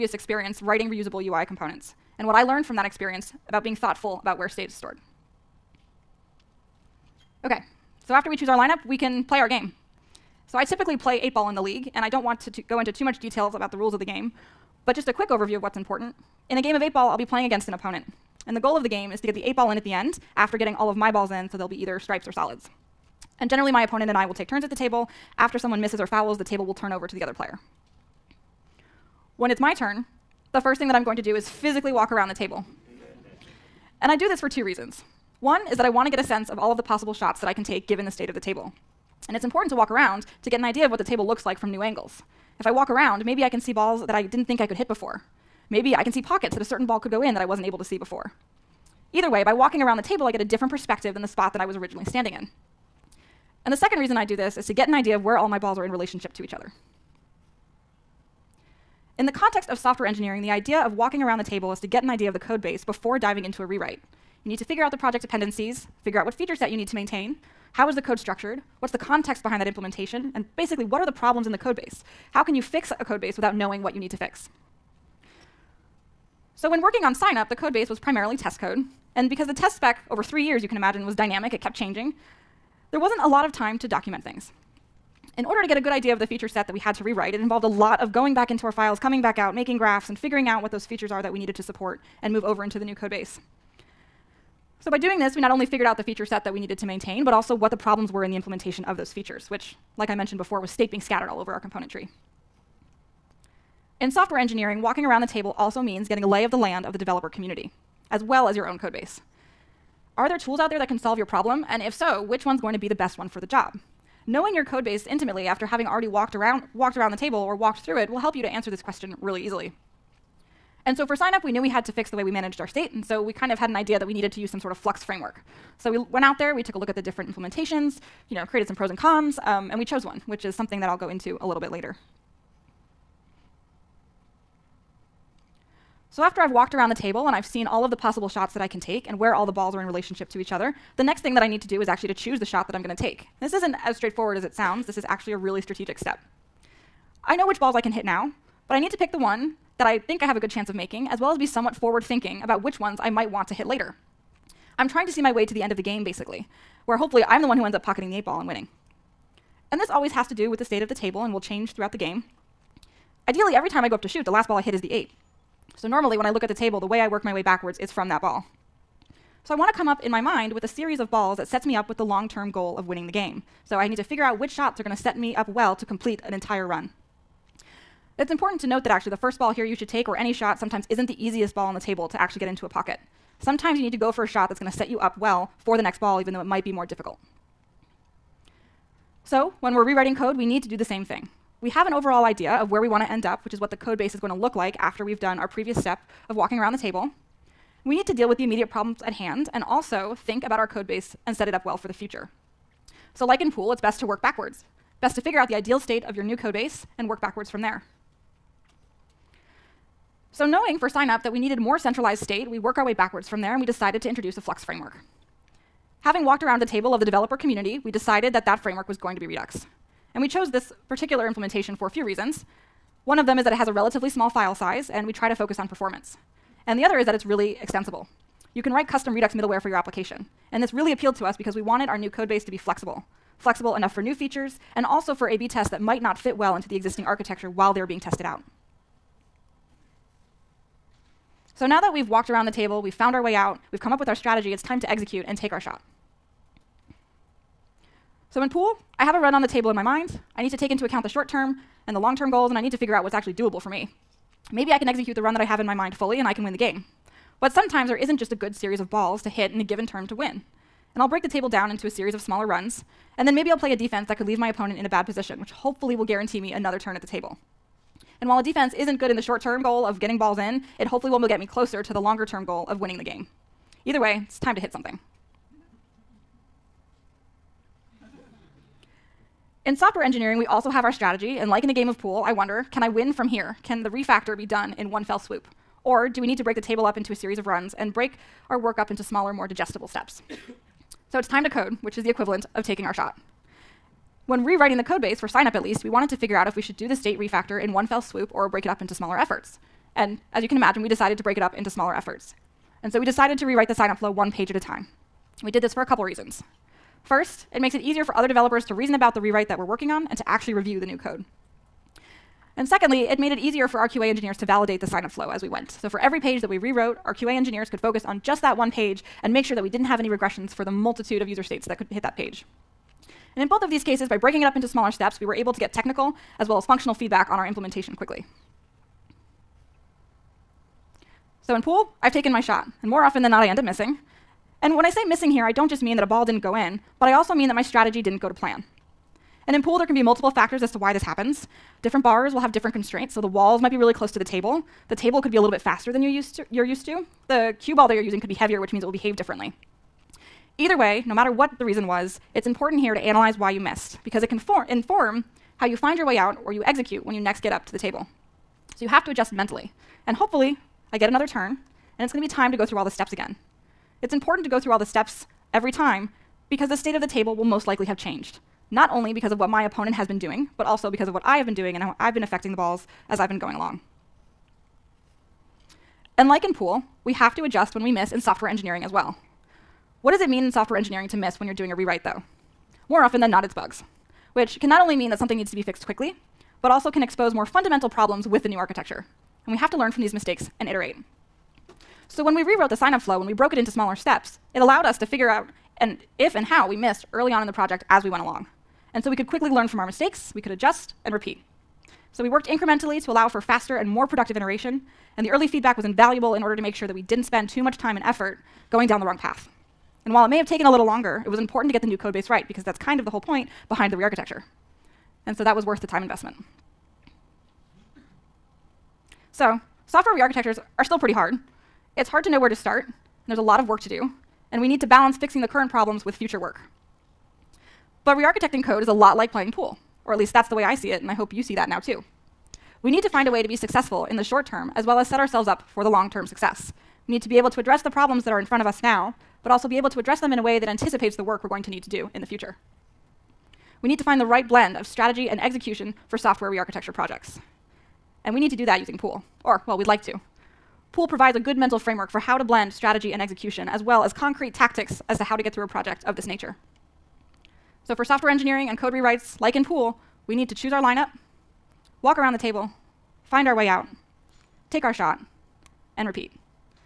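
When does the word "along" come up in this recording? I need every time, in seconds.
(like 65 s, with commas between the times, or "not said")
373 s, 398 s.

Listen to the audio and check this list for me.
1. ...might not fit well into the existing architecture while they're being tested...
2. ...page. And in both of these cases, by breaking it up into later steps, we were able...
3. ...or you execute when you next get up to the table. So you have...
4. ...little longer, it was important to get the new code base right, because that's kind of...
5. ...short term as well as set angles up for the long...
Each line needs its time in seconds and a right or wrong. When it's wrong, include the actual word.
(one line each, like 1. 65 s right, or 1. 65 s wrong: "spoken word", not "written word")
1. 235 s right
2. 322 s wrong: "smaller", not "later"
3. 356 s right
4. 410 s right
5. 434 s wrong: "ourselves", not "angles".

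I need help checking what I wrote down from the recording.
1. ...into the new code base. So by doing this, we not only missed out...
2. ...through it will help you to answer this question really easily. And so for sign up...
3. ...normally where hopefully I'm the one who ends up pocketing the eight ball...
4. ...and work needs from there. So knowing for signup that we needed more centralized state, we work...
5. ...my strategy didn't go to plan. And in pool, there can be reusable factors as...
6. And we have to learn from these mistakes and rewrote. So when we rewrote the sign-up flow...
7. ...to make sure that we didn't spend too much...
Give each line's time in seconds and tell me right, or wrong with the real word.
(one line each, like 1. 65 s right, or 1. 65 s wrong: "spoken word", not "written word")
1. 92 s wrong: "figured", not "missed"
2. 117 s right
3. 156 s wrong: "basically", not "normally"
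4. 206 s wrong: "backwards", not "needs"
5. 337 s wrong: "multiple", not "reusable"
6. 389 s wrong: "iterate", not "rewrote"
7. 406 s right.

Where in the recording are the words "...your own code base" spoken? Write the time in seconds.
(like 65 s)
108 s.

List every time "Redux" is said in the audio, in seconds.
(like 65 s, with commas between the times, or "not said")
219 s, 229 s.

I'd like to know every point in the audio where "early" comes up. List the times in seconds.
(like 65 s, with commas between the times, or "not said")
397 s, 405 s.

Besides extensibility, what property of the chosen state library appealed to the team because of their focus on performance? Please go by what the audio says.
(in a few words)
small file size.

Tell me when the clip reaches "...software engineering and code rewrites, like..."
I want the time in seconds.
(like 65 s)
458 s.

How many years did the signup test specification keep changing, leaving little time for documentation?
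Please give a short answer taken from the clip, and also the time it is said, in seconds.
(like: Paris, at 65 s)
3, at 80 s.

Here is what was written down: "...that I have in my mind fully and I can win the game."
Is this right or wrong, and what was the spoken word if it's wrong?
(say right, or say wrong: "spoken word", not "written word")
right.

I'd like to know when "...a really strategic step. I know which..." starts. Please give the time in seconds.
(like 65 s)
145 s.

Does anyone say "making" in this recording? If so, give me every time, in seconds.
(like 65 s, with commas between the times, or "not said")
89 s, 150 s.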